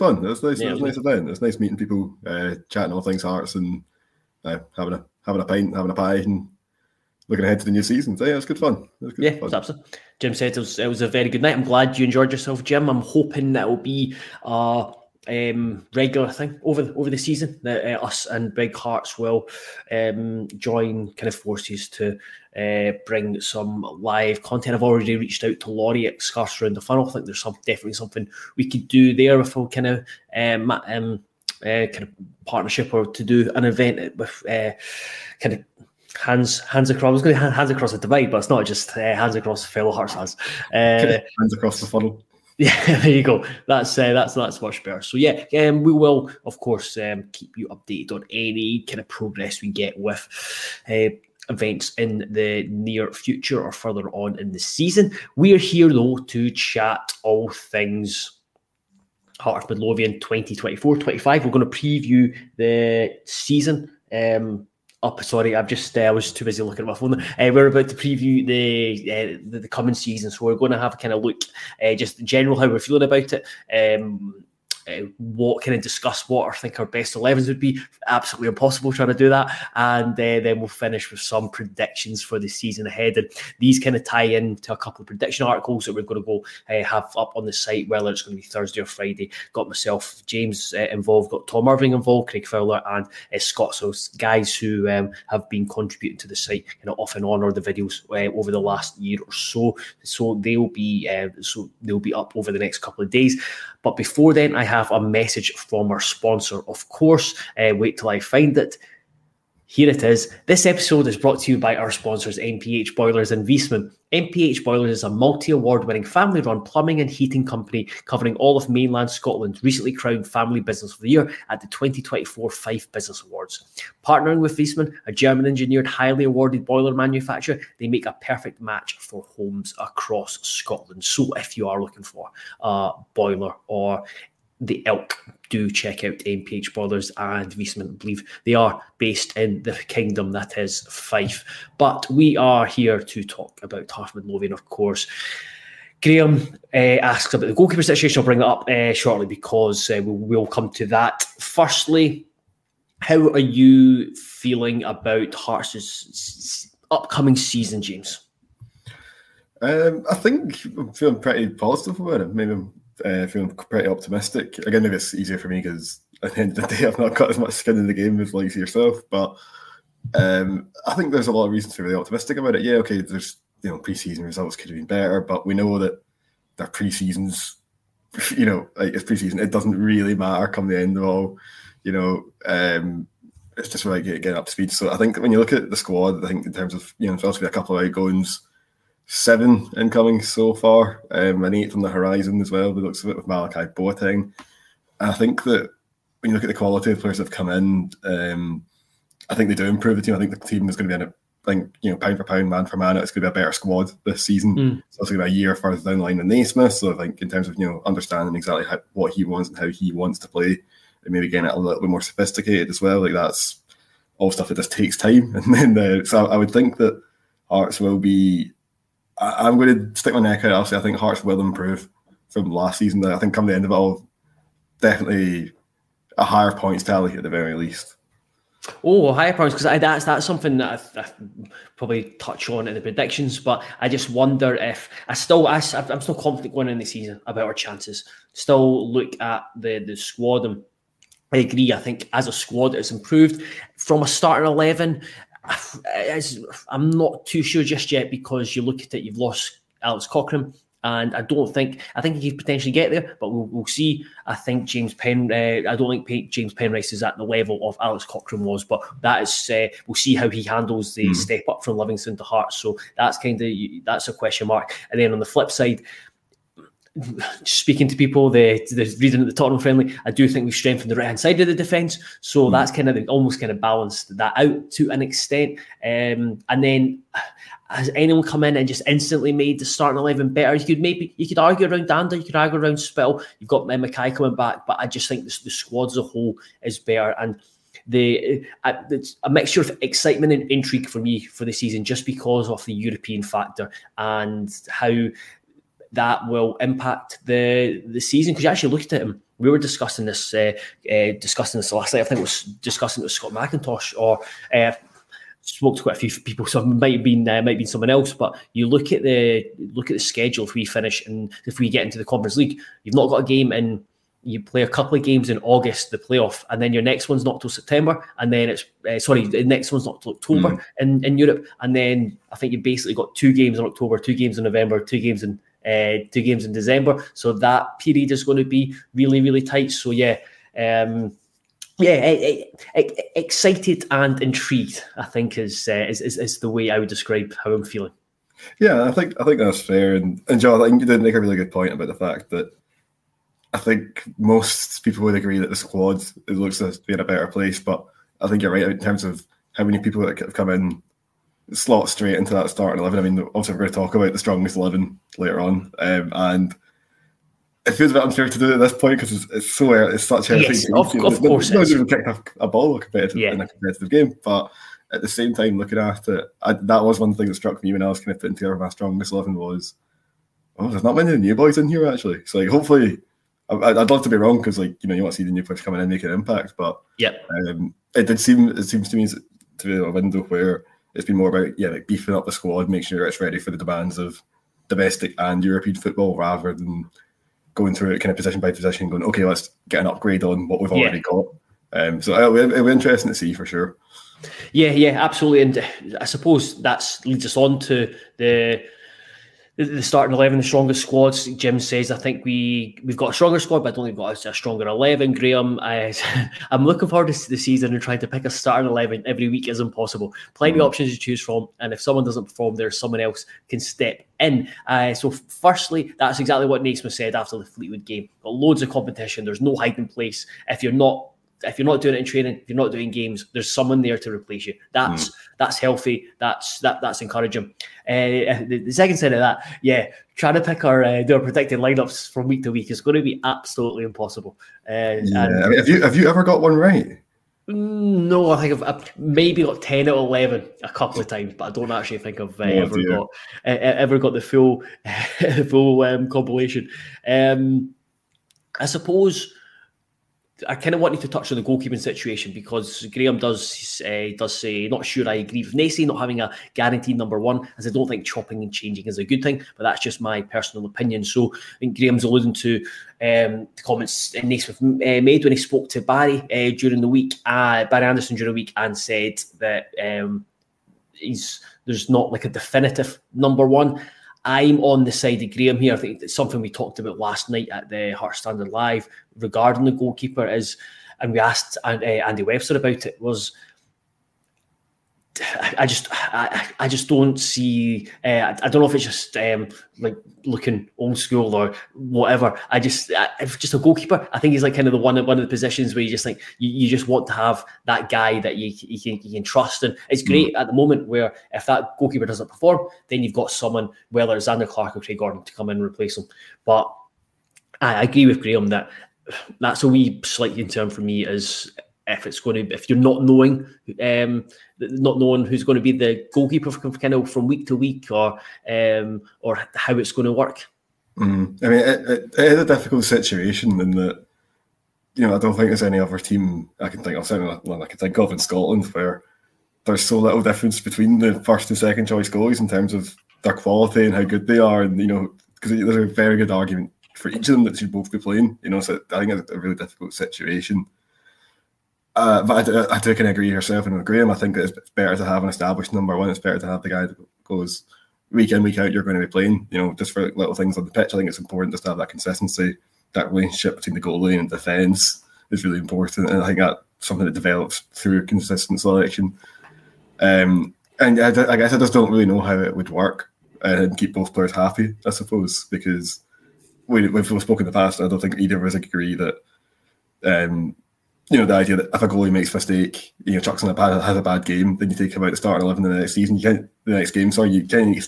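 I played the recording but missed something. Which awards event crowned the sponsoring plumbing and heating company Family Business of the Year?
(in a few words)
Fife Business Awards.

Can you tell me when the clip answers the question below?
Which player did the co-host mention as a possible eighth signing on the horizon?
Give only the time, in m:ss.
3:13.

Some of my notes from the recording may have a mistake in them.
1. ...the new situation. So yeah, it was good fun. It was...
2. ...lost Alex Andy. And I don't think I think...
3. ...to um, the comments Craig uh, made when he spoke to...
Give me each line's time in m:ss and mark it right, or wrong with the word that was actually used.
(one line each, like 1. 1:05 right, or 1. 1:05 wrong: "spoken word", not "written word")
1. 0:07 wrong: "season", not "situation"
2. 4:09 wrong: "Cochrane", not "Andy"
3. 7:42 wrong: "Naismith", not "Craig".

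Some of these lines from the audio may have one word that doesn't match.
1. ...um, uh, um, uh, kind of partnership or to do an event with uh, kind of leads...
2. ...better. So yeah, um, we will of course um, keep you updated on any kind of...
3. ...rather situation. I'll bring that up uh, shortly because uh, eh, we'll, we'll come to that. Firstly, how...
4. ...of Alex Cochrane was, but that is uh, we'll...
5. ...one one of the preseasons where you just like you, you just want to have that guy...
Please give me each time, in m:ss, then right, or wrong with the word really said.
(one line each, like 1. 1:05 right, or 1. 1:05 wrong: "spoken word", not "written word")
1. 0:30 wrong: "hands", not "leads"
2. 0:44 right
3. 2:27 wrong: "goalkeeper", not "rather"
4. 4:17 right
5. 8:14 wrong: "positions", not "preseasons".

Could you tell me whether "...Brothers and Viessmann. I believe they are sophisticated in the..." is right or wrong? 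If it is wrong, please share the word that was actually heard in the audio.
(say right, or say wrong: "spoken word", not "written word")
wrong: "based", not "sophisticated".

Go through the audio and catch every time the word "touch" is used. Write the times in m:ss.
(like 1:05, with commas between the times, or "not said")
3:52, 7:31.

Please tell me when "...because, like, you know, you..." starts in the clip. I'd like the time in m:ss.
6:14.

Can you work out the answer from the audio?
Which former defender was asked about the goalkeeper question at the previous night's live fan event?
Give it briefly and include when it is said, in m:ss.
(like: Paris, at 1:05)
Andy Webster, at 8:01.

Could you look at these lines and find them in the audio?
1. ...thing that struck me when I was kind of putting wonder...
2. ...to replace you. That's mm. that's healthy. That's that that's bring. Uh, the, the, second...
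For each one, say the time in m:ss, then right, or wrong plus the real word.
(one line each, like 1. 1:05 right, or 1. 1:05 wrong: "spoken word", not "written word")
1. 6:07 wrong: "together", not "wonder"
2. 7:03 wrong: "encouraging", not "bring".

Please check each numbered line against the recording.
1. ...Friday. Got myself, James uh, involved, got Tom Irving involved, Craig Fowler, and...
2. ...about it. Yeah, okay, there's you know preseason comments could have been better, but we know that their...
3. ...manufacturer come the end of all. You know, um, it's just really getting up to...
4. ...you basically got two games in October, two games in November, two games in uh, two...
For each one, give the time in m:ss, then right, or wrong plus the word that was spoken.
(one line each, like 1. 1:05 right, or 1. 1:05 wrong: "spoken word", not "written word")
1. 1:28 right
2. 2:52 wrong: "results", not "comments"
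3. 3:00 wrong: "matter", not "manufacturer"
4. 5:22 right.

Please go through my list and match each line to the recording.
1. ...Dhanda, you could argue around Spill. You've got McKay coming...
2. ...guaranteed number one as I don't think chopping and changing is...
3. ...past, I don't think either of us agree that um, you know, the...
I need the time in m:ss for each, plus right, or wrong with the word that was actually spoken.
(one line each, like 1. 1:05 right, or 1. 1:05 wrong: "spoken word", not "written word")
1. 4:41 right
2. 7:36 right
3. 9:27 right.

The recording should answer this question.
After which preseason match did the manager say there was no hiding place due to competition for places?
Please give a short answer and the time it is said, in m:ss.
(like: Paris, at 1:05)
Fleetwood, at 6:57.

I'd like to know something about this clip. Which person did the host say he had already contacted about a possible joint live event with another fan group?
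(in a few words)
Laurie.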